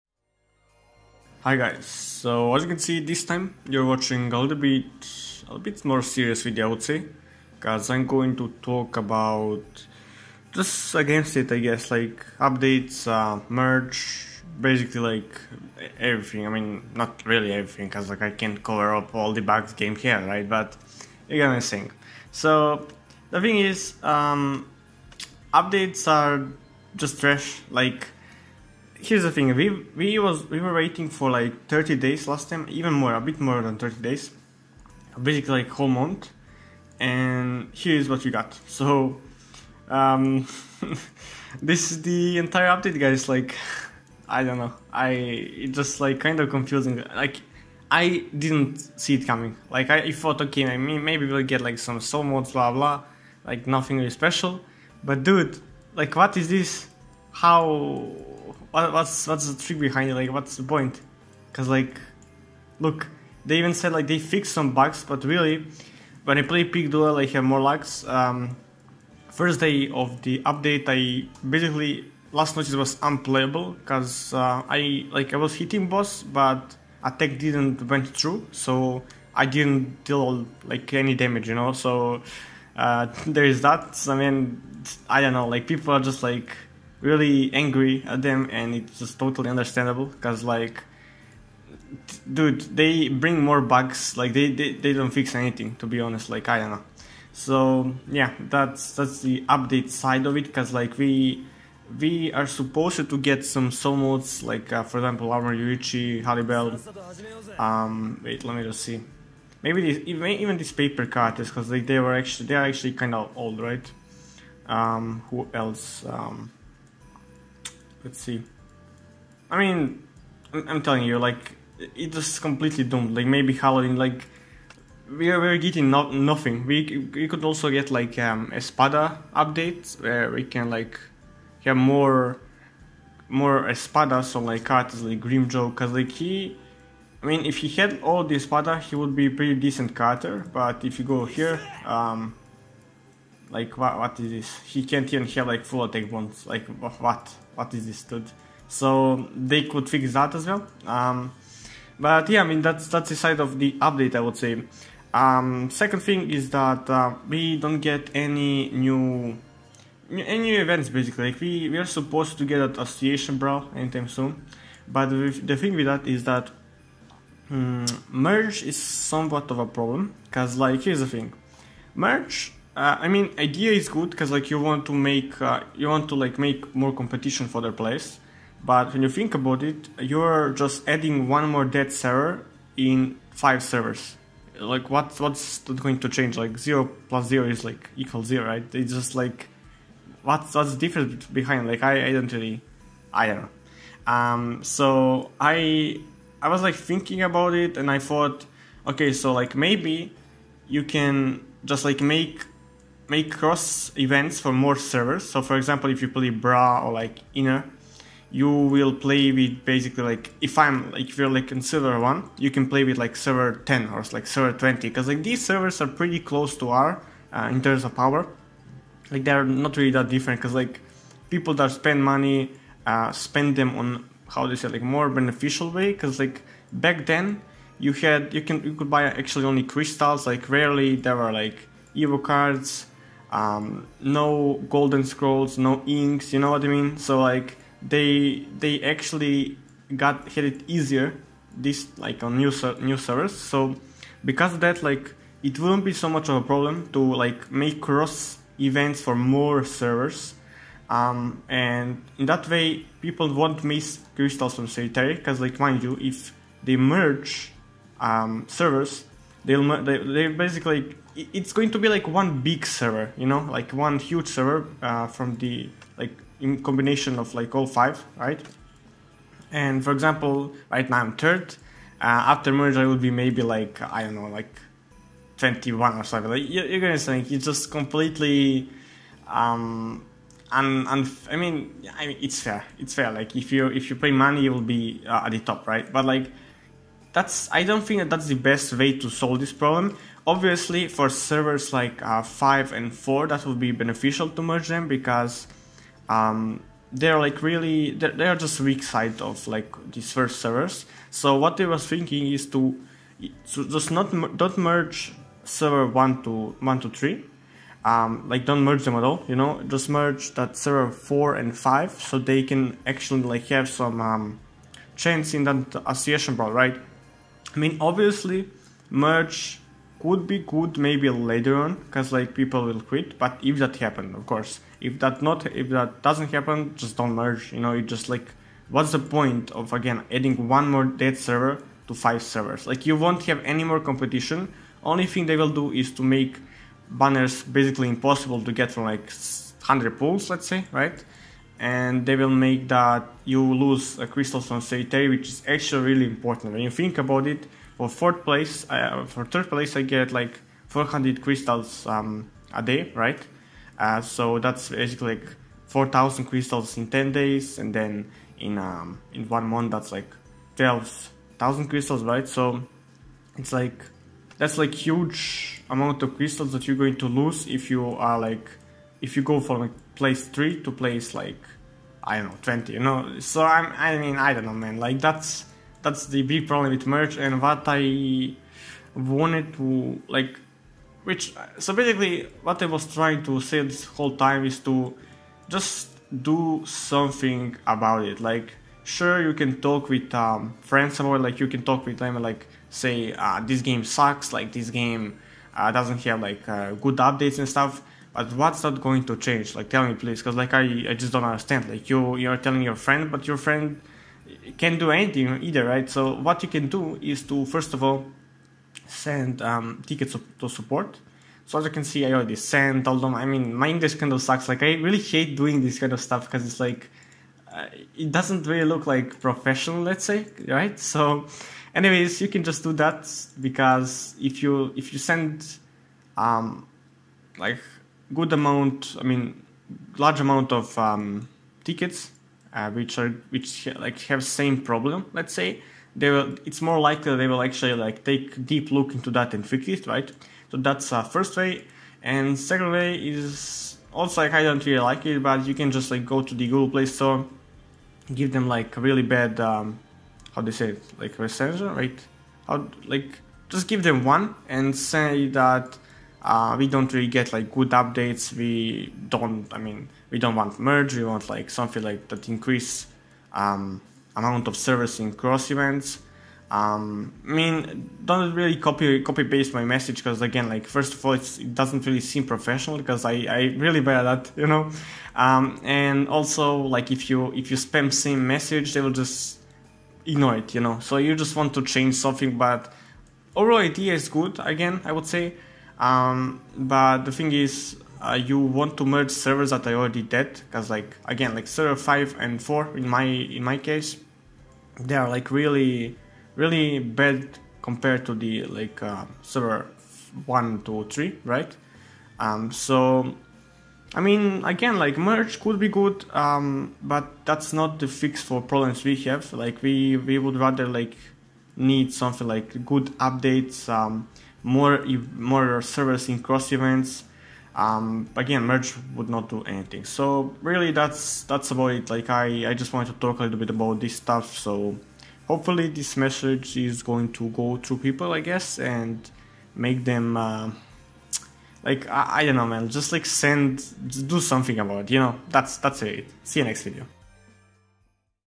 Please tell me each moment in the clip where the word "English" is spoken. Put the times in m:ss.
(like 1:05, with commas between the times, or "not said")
6:53.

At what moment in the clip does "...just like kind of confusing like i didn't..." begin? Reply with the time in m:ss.
0:45.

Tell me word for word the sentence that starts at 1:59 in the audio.
I mean, I'm telling you, like, it just completely doomed.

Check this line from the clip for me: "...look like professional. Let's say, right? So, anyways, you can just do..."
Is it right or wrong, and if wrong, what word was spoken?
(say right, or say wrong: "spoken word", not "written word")
right.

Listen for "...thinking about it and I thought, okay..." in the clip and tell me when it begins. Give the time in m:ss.
3:16.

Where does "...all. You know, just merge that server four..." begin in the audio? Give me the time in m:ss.
5:09.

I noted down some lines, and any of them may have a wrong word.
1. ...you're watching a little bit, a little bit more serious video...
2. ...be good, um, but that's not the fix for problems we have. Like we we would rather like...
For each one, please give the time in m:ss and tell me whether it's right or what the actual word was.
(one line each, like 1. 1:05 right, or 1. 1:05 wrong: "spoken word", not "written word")
1. 0:03 right
2. 8:25 right.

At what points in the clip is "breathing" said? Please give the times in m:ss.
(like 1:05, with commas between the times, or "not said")
not said.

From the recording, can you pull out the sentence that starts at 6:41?
Like, you you're telling your friend, but your friend can't do anything either, right?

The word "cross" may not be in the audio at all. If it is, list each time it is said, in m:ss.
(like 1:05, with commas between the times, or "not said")
3:23, 4:07, 7:45, 8:36.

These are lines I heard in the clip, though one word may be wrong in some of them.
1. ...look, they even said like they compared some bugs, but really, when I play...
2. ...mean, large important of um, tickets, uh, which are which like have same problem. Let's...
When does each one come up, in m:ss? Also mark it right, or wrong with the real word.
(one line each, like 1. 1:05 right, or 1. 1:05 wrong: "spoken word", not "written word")
1. 1:02 wrong: "fixed", not "compared"
2. 7:09 wrong: "amount", not "important".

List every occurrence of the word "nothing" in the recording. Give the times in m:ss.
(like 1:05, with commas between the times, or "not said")
0:53, 2:06.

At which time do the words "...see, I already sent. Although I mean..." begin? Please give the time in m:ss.
6:51.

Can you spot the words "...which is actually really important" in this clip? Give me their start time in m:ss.
5:45.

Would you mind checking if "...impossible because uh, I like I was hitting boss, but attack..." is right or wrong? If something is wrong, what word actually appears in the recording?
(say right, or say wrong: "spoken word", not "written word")
wrong: "unplayable", not "impossible".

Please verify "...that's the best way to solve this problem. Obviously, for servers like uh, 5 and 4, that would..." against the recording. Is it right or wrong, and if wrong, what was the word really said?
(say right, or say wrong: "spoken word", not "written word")
right.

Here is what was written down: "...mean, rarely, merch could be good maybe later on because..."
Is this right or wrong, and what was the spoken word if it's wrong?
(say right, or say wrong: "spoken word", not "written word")
wrong: "obviously", not "rarely".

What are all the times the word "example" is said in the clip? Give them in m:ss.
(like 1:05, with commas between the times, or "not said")
1:44, 3:25, 4:29.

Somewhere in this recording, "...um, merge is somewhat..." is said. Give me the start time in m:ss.
2:47.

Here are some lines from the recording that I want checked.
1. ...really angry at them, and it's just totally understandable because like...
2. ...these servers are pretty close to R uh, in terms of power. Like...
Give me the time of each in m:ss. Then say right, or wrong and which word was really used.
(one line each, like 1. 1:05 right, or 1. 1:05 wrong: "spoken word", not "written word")
1. 1:27 right
2. 3:35 right.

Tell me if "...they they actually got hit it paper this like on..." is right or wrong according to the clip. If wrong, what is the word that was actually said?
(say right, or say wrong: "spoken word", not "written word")
wrong: "easier", not "paper".